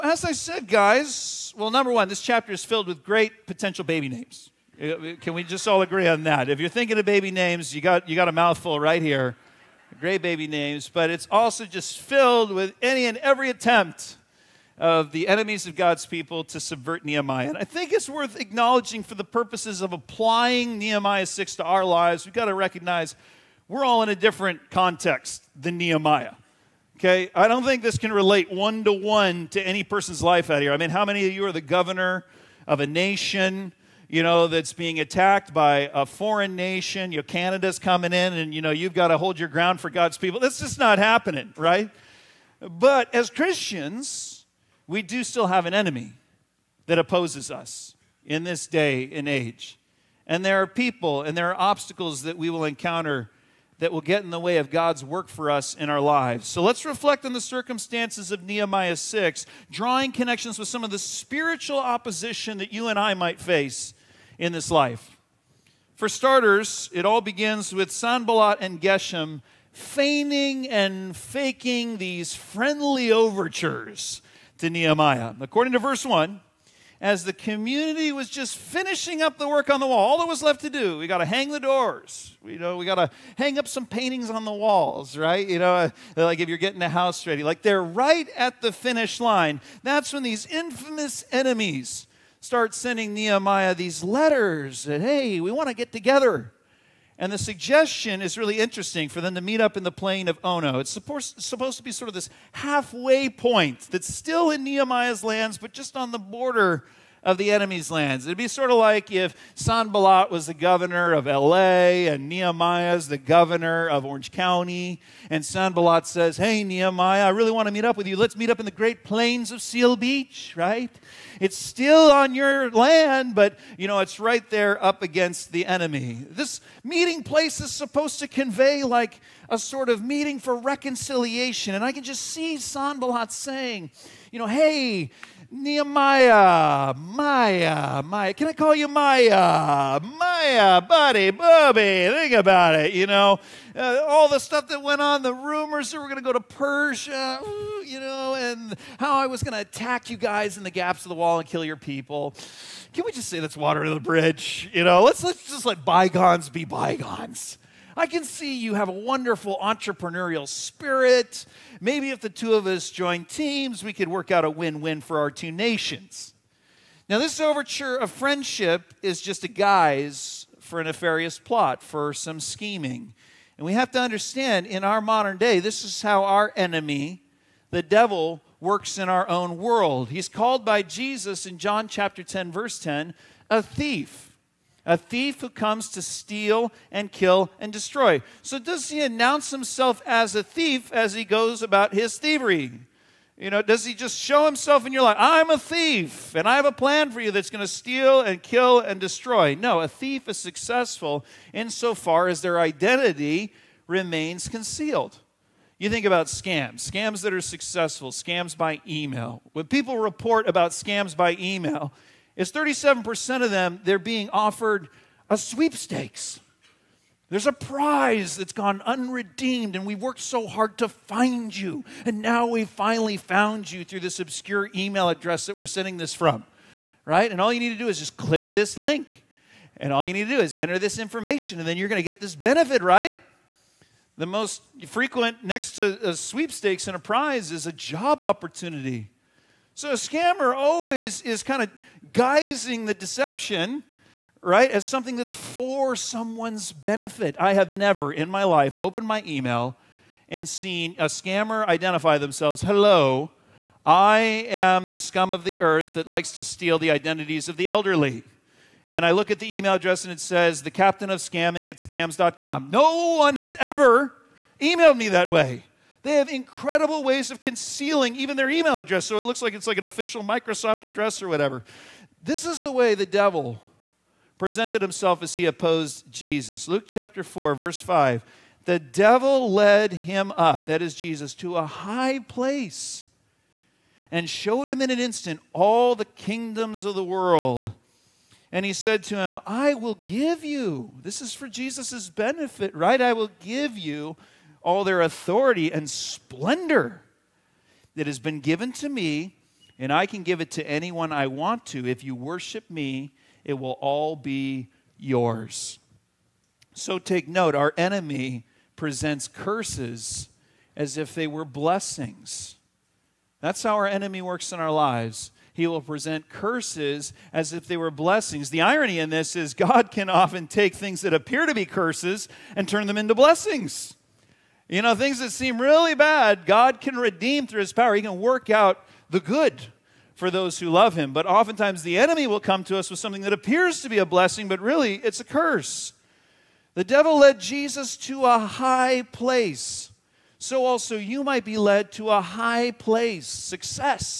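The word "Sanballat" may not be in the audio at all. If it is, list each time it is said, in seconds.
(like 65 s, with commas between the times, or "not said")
67 s, 109 s, 115 s, 132 s.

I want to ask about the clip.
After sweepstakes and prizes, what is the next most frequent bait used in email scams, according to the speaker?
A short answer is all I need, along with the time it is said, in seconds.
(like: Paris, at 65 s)
job opportunity, at 237 s.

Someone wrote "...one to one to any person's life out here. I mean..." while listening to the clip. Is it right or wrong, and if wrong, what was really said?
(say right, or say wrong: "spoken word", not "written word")
right.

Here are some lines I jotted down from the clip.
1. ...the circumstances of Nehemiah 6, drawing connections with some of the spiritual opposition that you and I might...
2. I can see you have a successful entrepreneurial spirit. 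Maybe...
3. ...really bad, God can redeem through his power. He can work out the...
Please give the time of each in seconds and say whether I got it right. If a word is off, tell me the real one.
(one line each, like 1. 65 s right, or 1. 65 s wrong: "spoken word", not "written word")
1. 57 s right
2. 157 s wrong: "wonderful", not "successful"
3. 325 s right.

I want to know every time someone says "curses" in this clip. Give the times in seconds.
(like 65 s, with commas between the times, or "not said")
309 s, 316 s, 321 s, 335 s.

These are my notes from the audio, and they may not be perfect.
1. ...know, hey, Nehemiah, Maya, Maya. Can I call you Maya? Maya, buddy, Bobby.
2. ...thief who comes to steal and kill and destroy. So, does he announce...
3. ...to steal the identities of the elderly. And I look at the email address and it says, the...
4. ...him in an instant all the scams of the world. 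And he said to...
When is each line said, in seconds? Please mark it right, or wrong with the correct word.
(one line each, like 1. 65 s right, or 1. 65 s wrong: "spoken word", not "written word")
1. 134 s right
2. 184 s right
3. 256 s right
4. 284 s wrong: "kingdoms", not "scams".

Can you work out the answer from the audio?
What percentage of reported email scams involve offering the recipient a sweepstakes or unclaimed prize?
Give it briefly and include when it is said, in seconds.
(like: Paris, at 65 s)
37%, at 212 s.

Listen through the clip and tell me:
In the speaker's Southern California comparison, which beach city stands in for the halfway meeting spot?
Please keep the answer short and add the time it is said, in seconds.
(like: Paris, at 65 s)
Seal Beach, at 119 s.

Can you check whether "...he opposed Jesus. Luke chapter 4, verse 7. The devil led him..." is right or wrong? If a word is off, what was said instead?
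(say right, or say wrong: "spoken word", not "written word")
wrong: "5", not "7".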